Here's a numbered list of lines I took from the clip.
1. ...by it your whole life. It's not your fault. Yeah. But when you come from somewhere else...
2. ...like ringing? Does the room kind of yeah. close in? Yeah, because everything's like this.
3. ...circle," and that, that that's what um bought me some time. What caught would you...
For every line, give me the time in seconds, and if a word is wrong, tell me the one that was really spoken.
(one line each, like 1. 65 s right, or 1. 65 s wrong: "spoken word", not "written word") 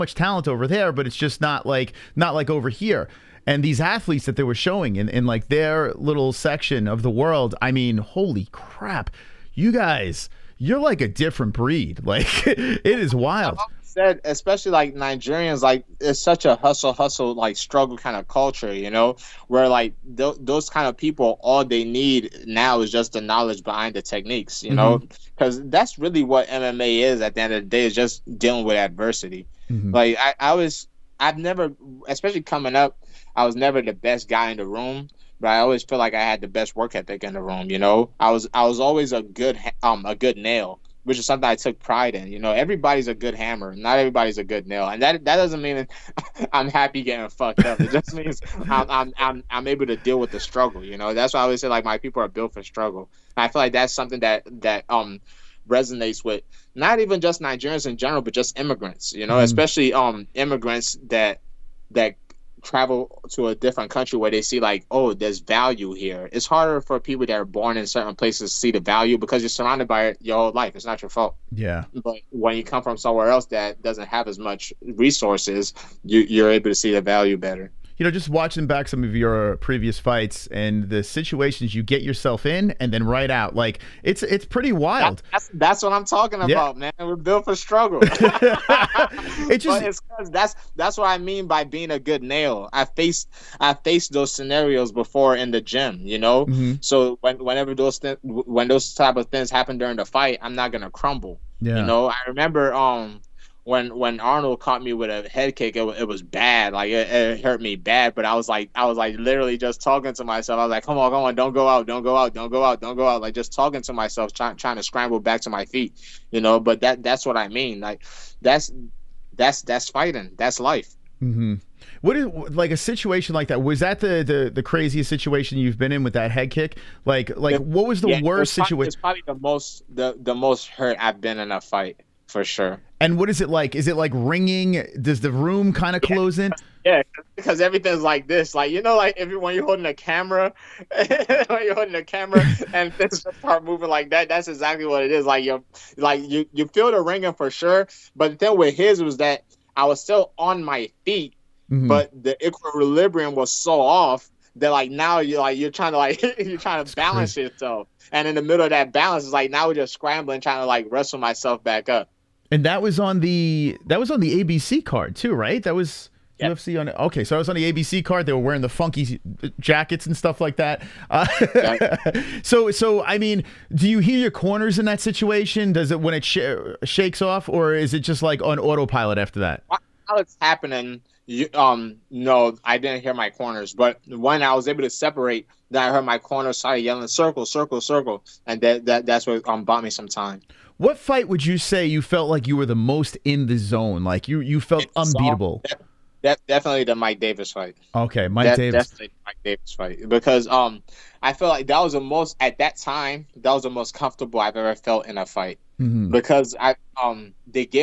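1. 69 s right
2. 133 s right
3. 187 s wrong: "fight", not "caught".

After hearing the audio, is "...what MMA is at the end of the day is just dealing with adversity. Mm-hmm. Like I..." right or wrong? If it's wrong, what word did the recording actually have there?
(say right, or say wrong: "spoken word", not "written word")
right.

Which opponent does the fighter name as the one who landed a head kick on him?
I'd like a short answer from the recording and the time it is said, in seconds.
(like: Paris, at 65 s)
Arnold, at 104 s.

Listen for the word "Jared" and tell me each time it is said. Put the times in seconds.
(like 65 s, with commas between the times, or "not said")
not said.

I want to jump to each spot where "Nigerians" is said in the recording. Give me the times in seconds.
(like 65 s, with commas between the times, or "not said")
14 s, 57 s.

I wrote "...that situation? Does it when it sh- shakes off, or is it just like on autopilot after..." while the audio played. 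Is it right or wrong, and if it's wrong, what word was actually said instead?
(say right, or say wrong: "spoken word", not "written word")
right.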